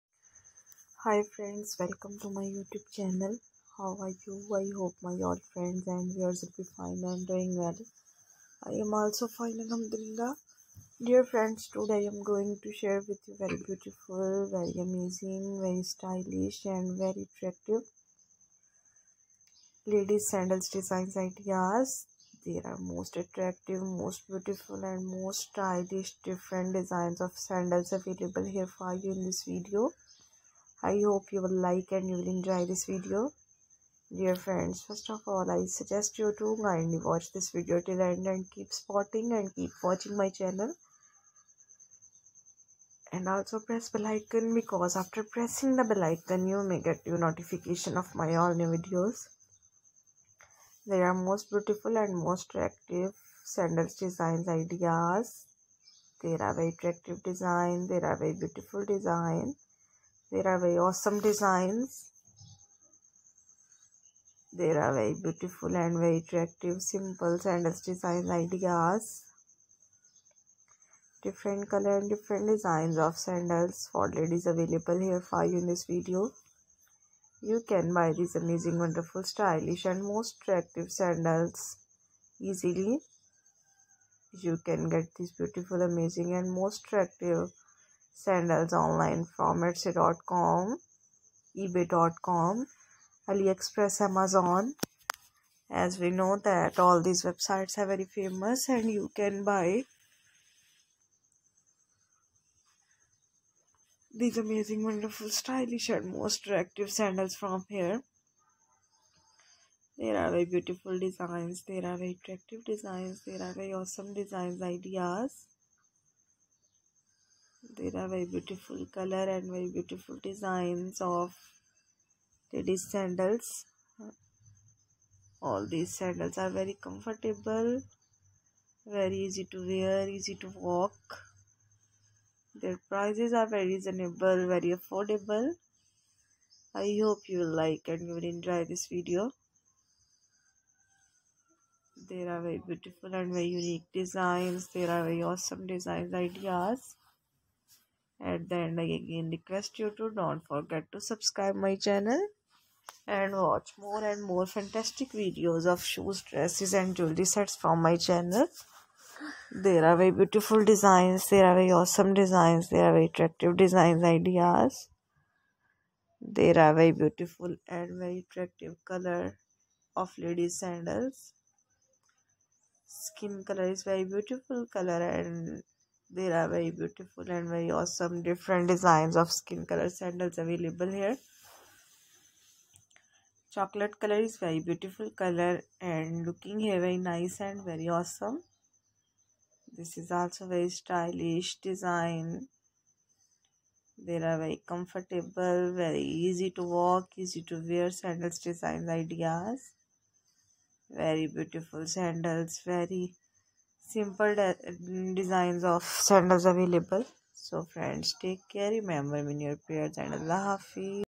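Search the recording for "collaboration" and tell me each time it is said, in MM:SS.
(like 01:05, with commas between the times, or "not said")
not said.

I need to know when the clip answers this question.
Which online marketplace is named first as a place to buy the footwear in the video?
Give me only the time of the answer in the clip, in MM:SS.
01:29.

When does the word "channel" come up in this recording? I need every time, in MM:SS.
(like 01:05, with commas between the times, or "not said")
00:02, 00:40, 02:31, 02:37.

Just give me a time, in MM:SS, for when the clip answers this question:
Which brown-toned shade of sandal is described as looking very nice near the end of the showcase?
03:03.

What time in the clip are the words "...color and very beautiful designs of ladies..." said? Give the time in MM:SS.
01:58.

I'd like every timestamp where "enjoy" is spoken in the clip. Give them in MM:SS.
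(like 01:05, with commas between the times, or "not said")
00:32, 02:18.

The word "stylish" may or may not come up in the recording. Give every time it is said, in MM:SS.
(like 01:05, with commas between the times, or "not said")
00:15, 00:25, 01:19, 01:45, 03:10.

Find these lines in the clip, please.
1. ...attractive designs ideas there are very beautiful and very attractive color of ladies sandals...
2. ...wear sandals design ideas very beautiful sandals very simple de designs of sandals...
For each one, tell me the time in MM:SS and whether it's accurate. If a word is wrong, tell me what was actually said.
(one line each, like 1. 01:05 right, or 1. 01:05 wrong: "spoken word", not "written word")
1. 02:43 right
2. 03:17 right.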